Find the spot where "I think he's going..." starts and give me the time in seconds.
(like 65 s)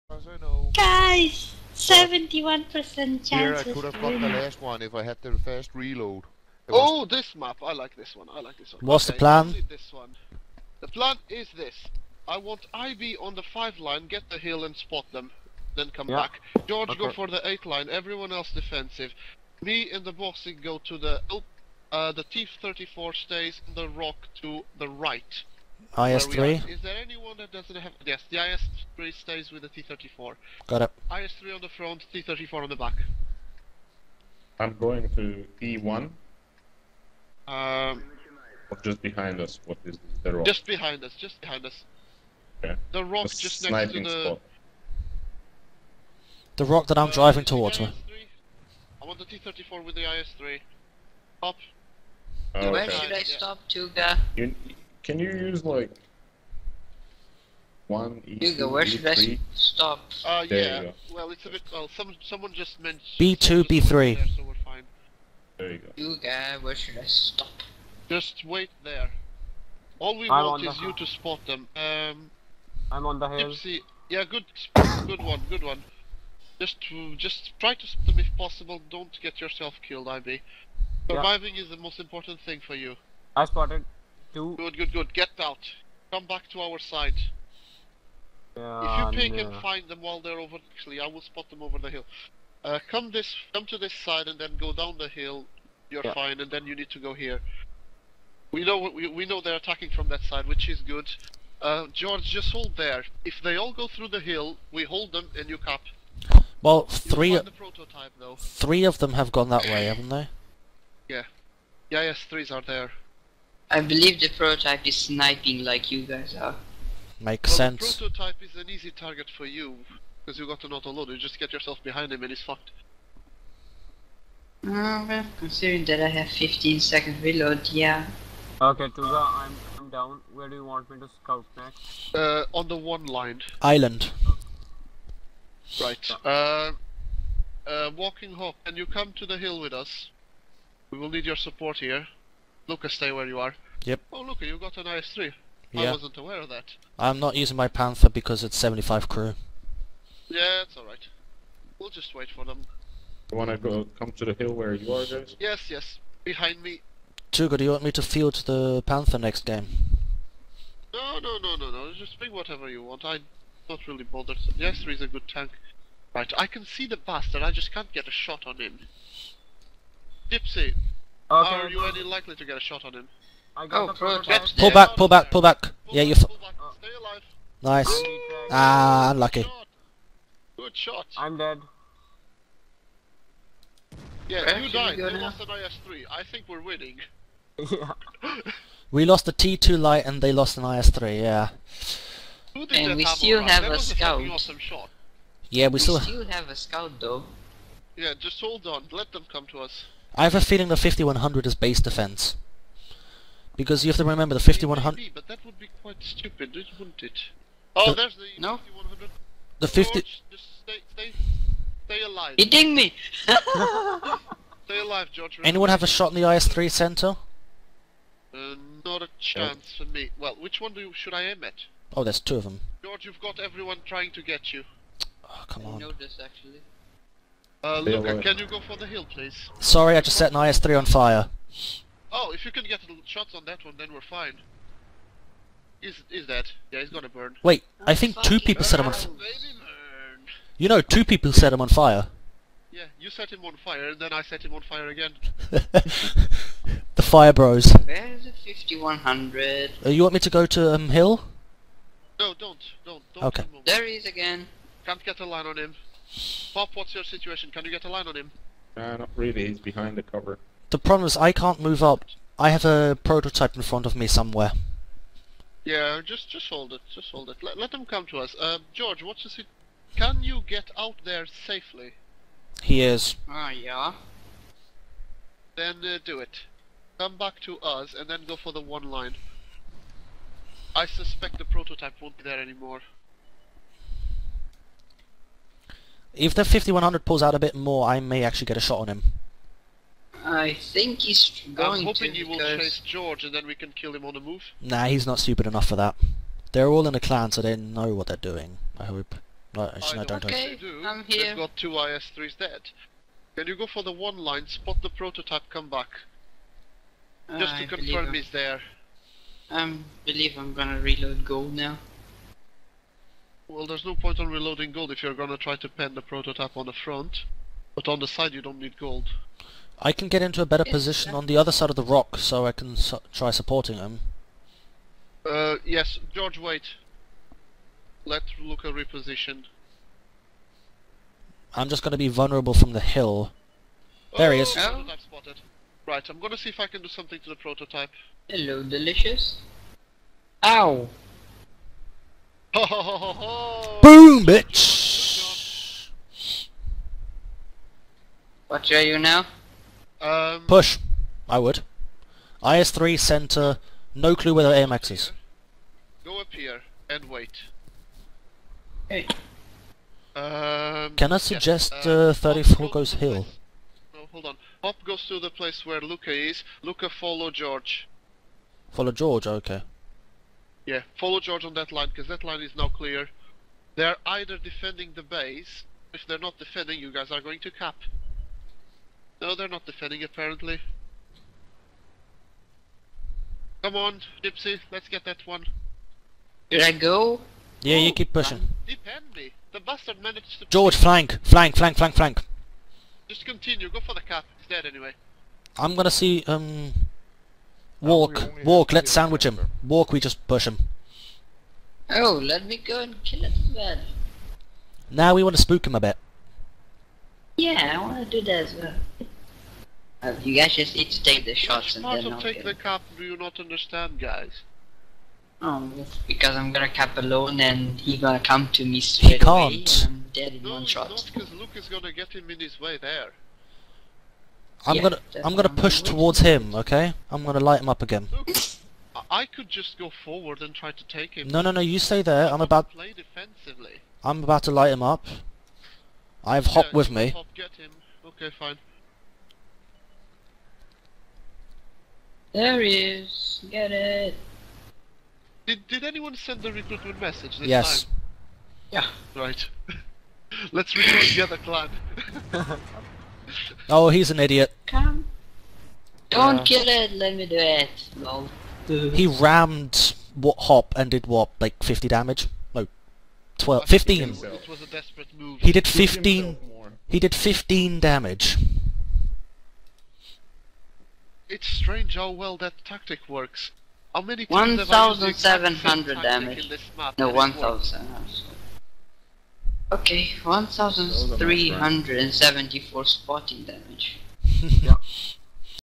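290 s.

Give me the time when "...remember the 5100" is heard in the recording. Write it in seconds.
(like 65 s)
204 s.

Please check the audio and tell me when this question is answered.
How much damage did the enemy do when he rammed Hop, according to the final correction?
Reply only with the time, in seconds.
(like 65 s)
466 s.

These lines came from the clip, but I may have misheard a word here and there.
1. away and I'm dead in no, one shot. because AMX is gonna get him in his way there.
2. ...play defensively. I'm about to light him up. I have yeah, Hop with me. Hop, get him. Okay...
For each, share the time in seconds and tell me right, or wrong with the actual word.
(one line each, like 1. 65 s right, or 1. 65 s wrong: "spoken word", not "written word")
1. 419 s wrong: "Luke", not "AMX"
2. 432 s right.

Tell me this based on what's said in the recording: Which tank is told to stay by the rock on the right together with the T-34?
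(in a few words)
IS-3.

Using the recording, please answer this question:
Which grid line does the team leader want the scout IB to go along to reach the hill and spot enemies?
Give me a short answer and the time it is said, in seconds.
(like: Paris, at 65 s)
5 line, at 13 s.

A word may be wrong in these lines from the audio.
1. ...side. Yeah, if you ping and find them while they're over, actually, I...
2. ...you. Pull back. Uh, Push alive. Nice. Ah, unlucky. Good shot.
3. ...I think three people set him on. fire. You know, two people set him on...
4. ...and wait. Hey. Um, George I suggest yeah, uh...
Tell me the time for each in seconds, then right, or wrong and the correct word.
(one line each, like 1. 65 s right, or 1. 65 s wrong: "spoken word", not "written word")
1. 86 s right
2. 176 s wrong: "Stay", not "Push"
3. 237 s wrong: "two", not "three"
4. 356 s wrong: "Can", not "George".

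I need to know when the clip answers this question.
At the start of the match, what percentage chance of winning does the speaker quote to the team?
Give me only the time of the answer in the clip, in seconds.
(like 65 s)
1 s.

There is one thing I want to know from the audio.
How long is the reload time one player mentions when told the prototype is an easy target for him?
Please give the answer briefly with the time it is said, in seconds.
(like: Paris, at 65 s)
15 seconds, at 126 s.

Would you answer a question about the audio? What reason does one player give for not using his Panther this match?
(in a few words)
75% crew.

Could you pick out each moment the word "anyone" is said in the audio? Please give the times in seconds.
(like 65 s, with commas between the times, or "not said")
27 s, 215 s, 445 s.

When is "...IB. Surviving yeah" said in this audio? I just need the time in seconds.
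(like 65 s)
80 s.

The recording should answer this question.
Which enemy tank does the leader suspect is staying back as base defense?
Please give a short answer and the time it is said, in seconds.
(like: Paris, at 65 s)
5100, at 200 s.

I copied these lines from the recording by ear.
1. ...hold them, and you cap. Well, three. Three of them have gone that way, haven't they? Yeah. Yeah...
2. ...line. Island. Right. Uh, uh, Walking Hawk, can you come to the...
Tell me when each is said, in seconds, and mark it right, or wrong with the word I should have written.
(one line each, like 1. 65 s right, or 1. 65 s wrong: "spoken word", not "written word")
1. 104 s right
2. 133 s right.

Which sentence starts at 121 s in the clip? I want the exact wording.
You just get yourself behind him and he's fucked.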